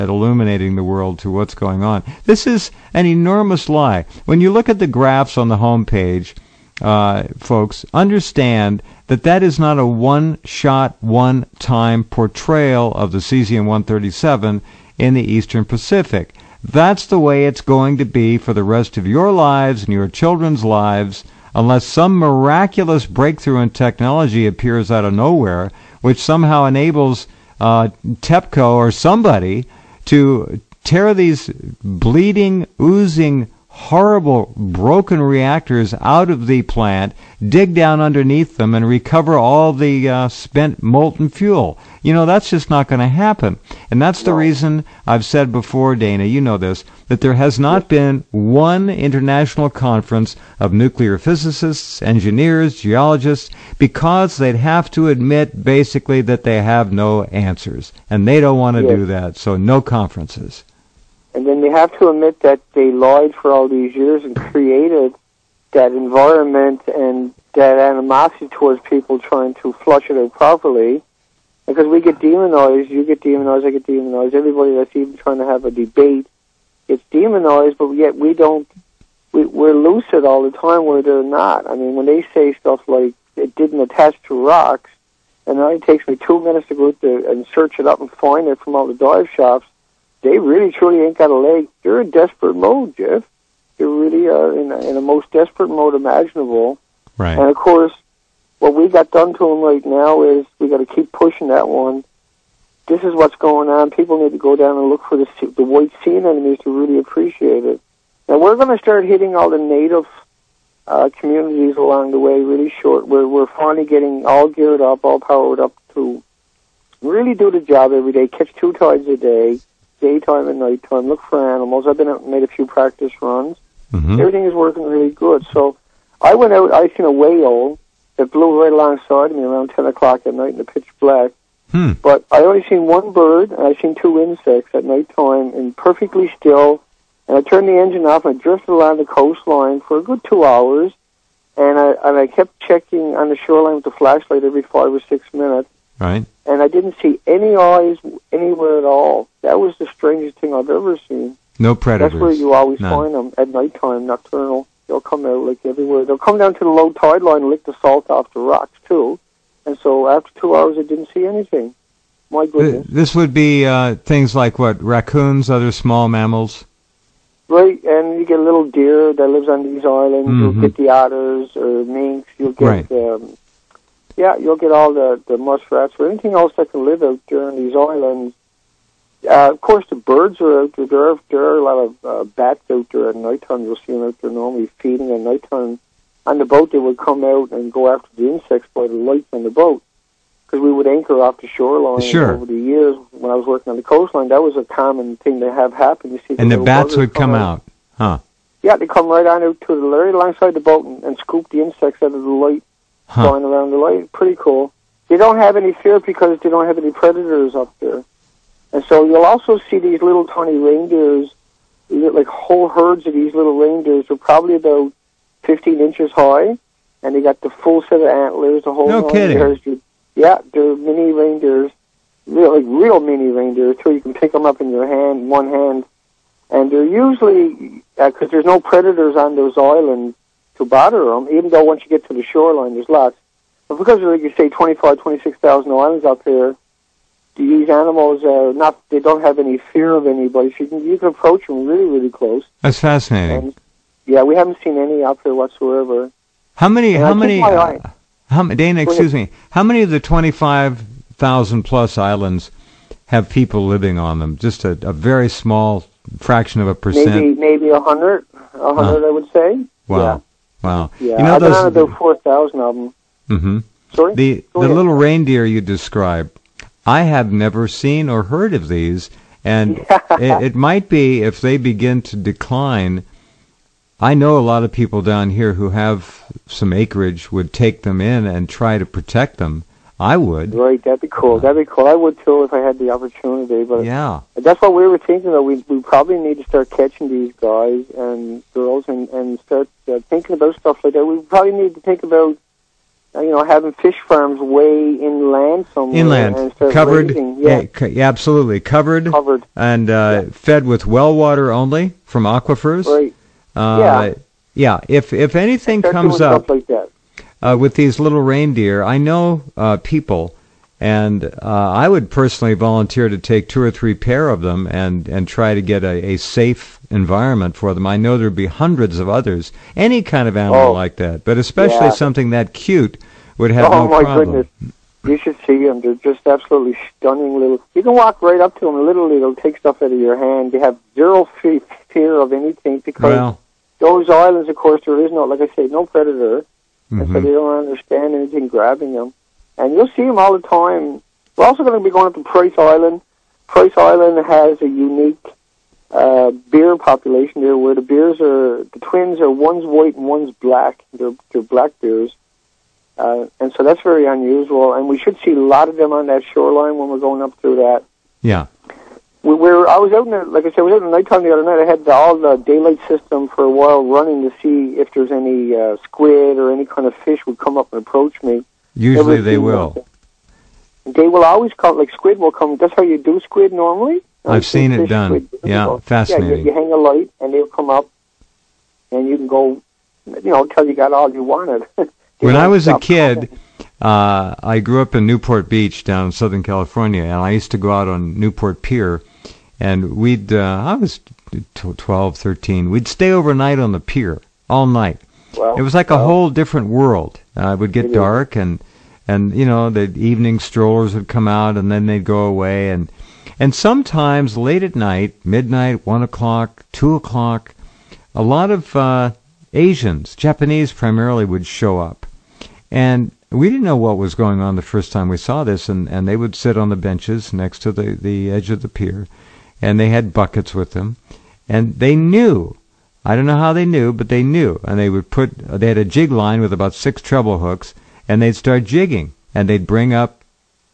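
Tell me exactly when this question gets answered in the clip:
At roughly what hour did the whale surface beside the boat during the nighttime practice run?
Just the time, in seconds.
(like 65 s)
129 s.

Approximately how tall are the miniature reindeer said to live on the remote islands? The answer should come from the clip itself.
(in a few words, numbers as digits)
15 inches.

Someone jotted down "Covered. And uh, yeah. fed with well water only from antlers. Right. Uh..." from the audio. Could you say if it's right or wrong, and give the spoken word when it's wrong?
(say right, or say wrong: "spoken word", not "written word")
wrong: "aquifers", not "antlers".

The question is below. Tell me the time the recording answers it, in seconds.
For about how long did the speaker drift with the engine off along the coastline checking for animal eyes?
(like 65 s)
139 s.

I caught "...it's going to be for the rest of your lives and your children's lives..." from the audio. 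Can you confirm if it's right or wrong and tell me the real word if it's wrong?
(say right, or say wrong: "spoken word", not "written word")
right.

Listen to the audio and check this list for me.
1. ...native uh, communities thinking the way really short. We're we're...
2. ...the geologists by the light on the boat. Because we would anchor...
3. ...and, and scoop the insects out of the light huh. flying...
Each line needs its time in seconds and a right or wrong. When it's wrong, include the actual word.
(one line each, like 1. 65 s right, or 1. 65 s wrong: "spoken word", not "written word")
1. 109 s wrong: "along", not "thinking"
2. 188 s wrong: "insects", not "geologists"
3. 200 s right.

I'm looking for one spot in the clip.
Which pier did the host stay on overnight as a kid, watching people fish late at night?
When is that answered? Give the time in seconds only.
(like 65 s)
388 s.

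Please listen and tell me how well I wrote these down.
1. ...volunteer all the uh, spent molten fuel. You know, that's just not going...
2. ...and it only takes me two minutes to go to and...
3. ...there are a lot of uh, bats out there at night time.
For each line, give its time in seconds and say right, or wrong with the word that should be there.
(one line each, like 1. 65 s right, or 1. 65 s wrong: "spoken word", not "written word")
1. 38 s wrong: "recover", not "volunteer"
2. 85 s right
3. 181 s right.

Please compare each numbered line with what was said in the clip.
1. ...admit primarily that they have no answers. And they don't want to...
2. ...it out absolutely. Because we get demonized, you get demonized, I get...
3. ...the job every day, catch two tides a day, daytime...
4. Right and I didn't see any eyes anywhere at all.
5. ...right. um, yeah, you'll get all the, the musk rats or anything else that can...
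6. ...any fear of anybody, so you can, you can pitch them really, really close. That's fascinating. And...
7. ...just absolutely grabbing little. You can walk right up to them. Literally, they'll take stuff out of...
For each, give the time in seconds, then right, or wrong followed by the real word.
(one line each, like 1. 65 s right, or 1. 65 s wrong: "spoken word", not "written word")
1. 55 s wrong: "basically", not "primarily"
2. 70 s wrong: "properly", not "absolutely"
3. 117 s right
4. 145 s right
5. 172 s right
6. 239 s wrong: "approach", not "pitch"
7. 325 s wrong: "stunning", not "grabbing".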